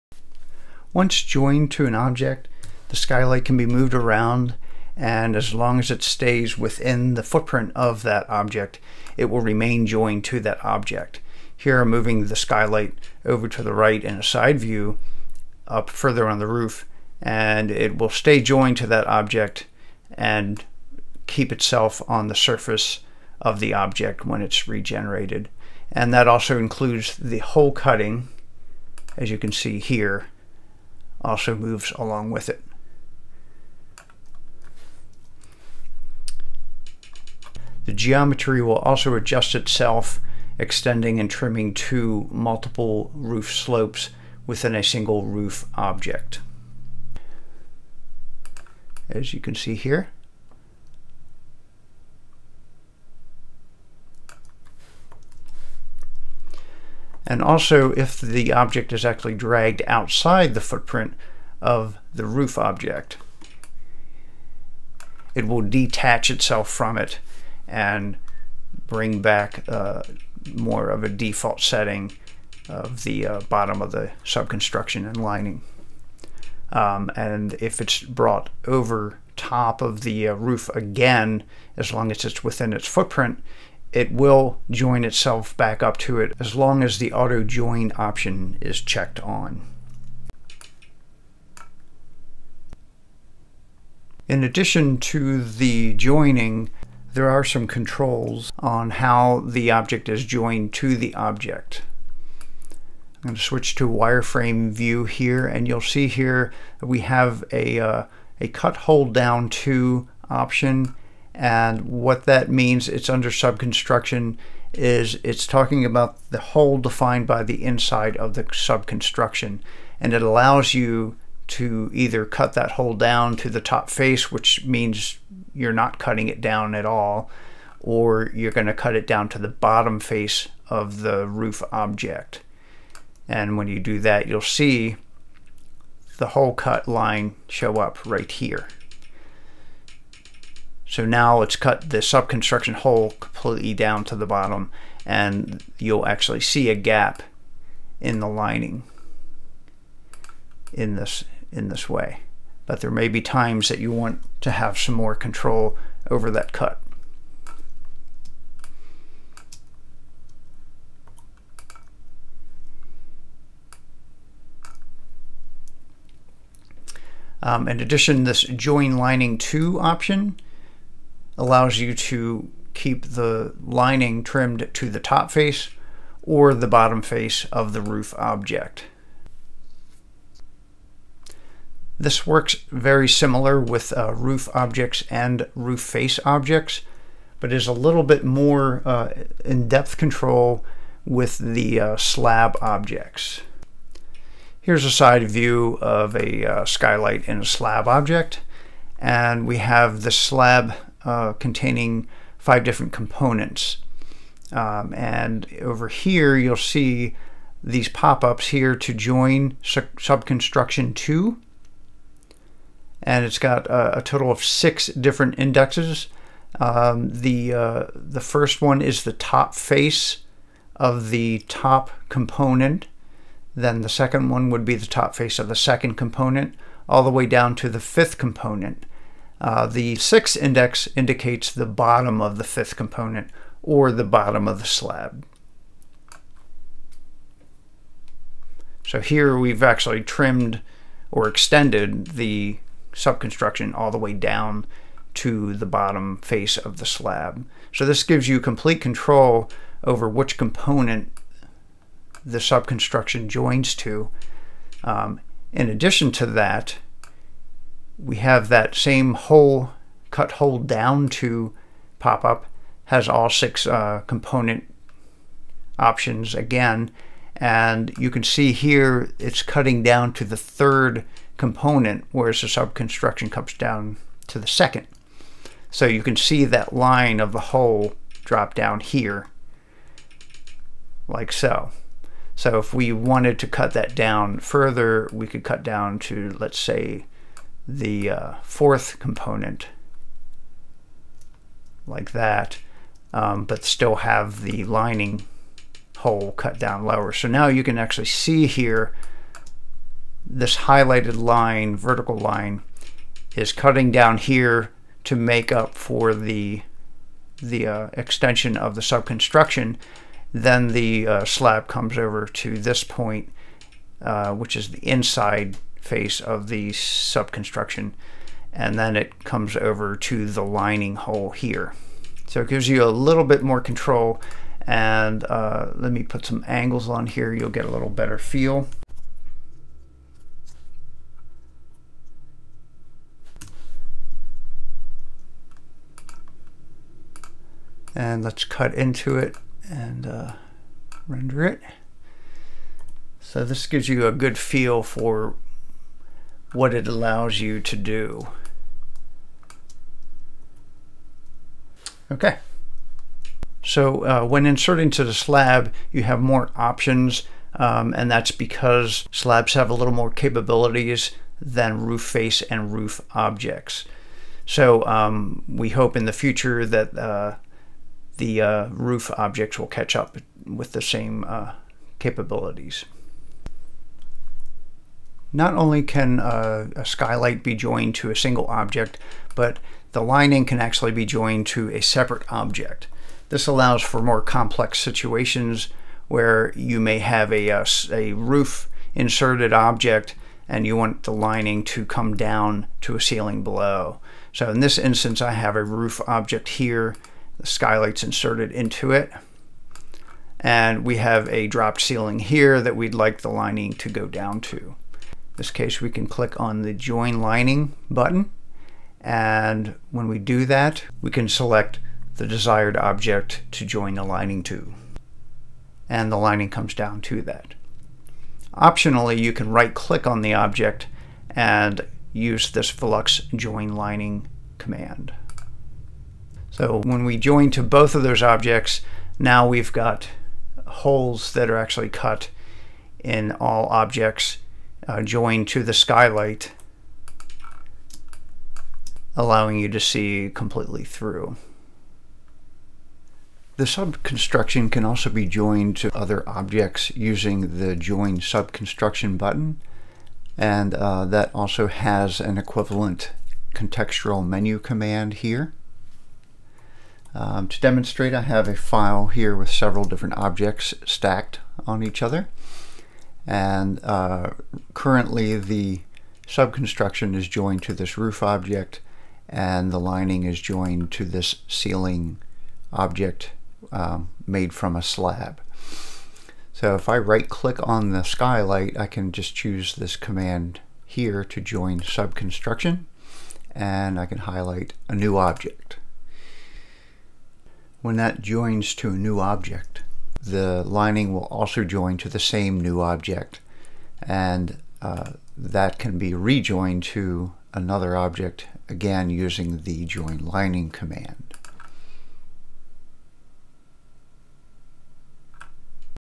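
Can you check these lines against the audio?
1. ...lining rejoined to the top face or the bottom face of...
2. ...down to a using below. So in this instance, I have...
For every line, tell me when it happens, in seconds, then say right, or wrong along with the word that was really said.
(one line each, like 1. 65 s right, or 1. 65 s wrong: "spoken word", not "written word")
1. 173 s wrong: "trimmed", not "rejoined"
2. 392 s wrong: "ceiling", not "using".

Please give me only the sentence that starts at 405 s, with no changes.
In this case, we can click on the Join Lining button.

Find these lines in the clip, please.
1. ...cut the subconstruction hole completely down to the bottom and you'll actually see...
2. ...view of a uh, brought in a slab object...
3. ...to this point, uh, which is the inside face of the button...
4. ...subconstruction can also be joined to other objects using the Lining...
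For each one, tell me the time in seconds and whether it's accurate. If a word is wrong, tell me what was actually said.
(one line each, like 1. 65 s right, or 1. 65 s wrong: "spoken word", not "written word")
1. 141 s right
2. 195 s wrong: "skylight", not "brought"
3. 312 s wrong: "subconstruction", not "button"
4. 443 s wrong: "Join", not "Lining".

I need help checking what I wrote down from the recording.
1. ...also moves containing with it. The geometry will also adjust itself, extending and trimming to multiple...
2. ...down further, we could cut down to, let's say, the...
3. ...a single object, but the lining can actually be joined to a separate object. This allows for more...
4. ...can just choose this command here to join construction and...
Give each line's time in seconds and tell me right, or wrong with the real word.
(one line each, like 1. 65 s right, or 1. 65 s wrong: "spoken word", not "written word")
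1. 31 s wrong: "along", not "containing"
2. 283 s right
3. 378 s right
4. 478 s wrong: "subconstruction", not "construction".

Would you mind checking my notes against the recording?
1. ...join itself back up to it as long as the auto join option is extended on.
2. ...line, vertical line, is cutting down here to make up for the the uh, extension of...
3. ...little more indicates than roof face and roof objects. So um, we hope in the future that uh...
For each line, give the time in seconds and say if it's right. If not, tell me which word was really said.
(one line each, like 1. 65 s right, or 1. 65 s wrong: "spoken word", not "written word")
1. 84 s wrong: "checked", not "extended"
2. 301 s right
3. 359 s wrong: "capabilities", not "indicates".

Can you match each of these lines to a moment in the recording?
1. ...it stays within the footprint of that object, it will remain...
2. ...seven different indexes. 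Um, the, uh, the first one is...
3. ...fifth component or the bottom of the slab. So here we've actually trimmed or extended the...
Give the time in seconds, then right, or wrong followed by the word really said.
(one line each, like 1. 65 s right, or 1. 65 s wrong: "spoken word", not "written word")
1. 5 s right
2. 214 s wrong: "six", not "seven"
3. 232 s right.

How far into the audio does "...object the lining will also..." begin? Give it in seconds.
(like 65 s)
489 s.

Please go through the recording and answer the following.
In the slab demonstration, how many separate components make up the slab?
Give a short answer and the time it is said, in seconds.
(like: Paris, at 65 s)
5, at 202 s.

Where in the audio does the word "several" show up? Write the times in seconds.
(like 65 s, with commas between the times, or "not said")
459 s.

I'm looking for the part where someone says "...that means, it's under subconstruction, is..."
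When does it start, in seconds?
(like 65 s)
112 s.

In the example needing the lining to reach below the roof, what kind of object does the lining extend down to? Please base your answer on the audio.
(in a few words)
dropped ceiling.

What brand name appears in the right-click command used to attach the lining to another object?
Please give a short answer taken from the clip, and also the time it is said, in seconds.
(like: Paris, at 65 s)
VELUX, at 422 s.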